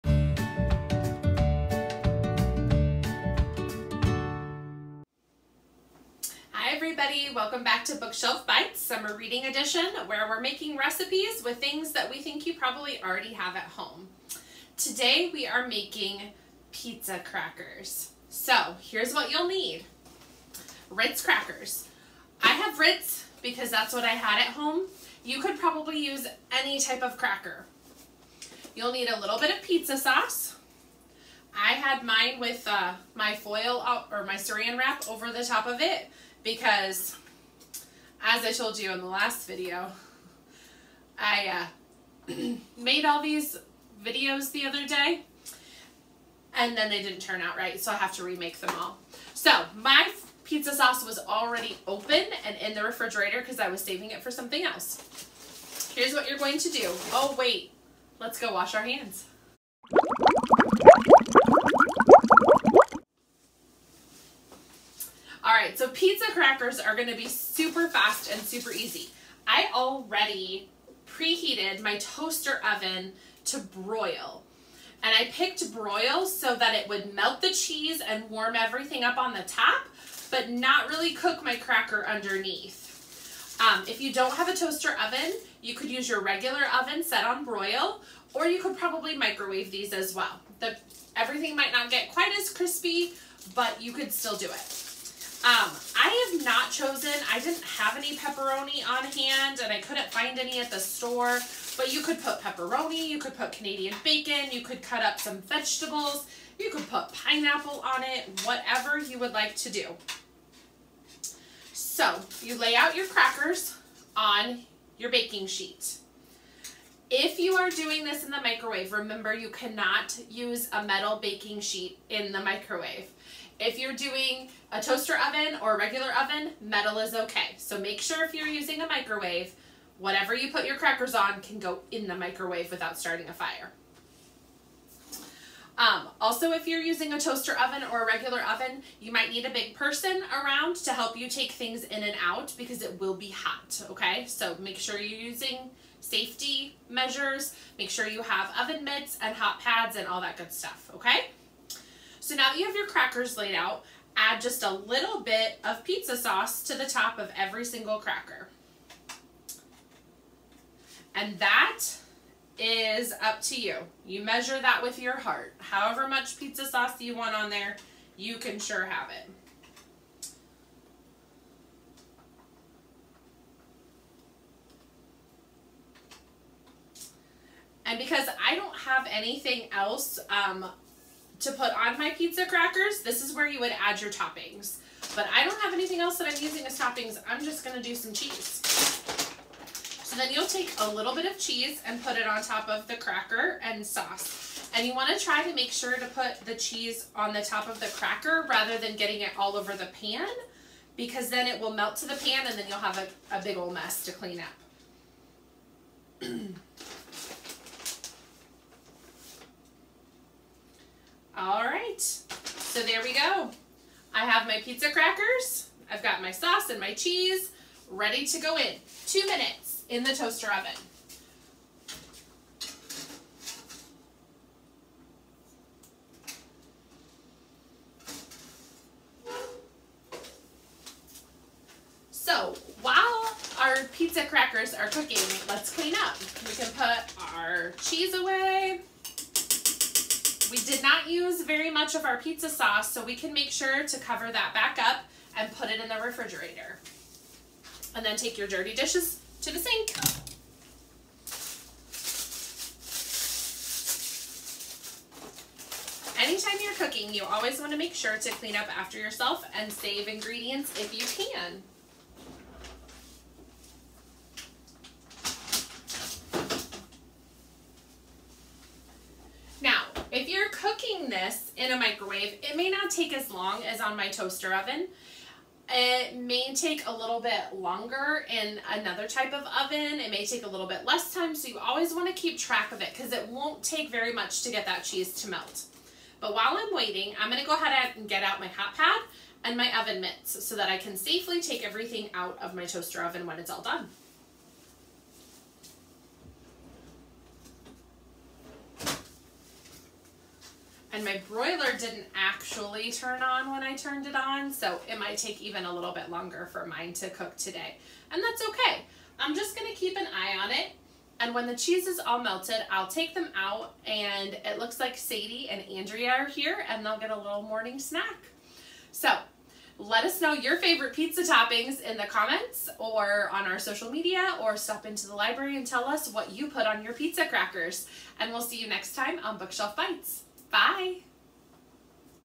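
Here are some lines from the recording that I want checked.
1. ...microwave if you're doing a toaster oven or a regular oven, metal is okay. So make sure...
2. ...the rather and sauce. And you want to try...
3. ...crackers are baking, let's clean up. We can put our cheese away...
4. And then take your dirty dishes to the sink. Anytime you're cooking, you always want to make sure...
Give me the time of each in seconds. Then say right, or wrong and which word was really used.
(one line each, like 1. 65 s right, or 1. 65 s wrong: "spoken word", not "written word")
1. 122 s right
2. 192 s wrong: "cracker", not "rather"
3. 234 s wrong: "cooking", not "baking"
4. 247 s right.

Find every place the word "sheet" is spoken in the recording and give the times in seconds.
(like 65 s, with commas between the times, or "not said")
115 s, 121 s.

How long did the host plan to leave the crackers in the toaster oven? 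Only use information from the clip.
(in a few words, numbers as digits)
2 minutes.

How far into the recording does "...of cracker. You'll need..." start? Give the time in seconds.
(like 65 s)
27 s.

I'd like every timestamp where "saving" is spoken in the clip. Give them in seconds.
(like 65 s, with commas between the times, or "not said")
53 s.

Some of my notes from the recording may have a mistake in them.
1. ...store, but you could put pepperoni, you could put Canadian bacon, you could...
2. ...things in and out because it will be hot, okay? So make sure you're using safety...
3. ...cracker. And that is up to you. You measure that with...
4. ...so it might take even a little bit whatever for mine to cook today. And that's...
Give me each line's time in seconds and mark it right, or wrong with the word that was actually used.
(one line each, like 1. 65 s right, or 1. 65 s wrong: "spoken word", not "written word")
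1. 100 s right
2. 141 s right
3. 157 s right
4. 304 s wrong: "longer", not "whatever".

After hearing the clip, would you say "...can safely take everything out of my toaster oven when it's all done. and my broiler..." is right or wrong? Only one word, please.
right.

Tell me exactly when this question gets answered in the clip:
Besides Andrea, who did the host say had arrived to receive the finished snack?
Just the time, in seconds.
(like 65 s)
314 s.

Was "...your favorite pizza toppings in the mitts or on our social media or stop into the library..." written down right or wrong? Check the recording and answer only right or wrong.
wrong.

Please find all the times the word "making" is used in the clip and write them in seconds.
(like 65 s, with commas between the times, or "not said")
10 s, 15 s.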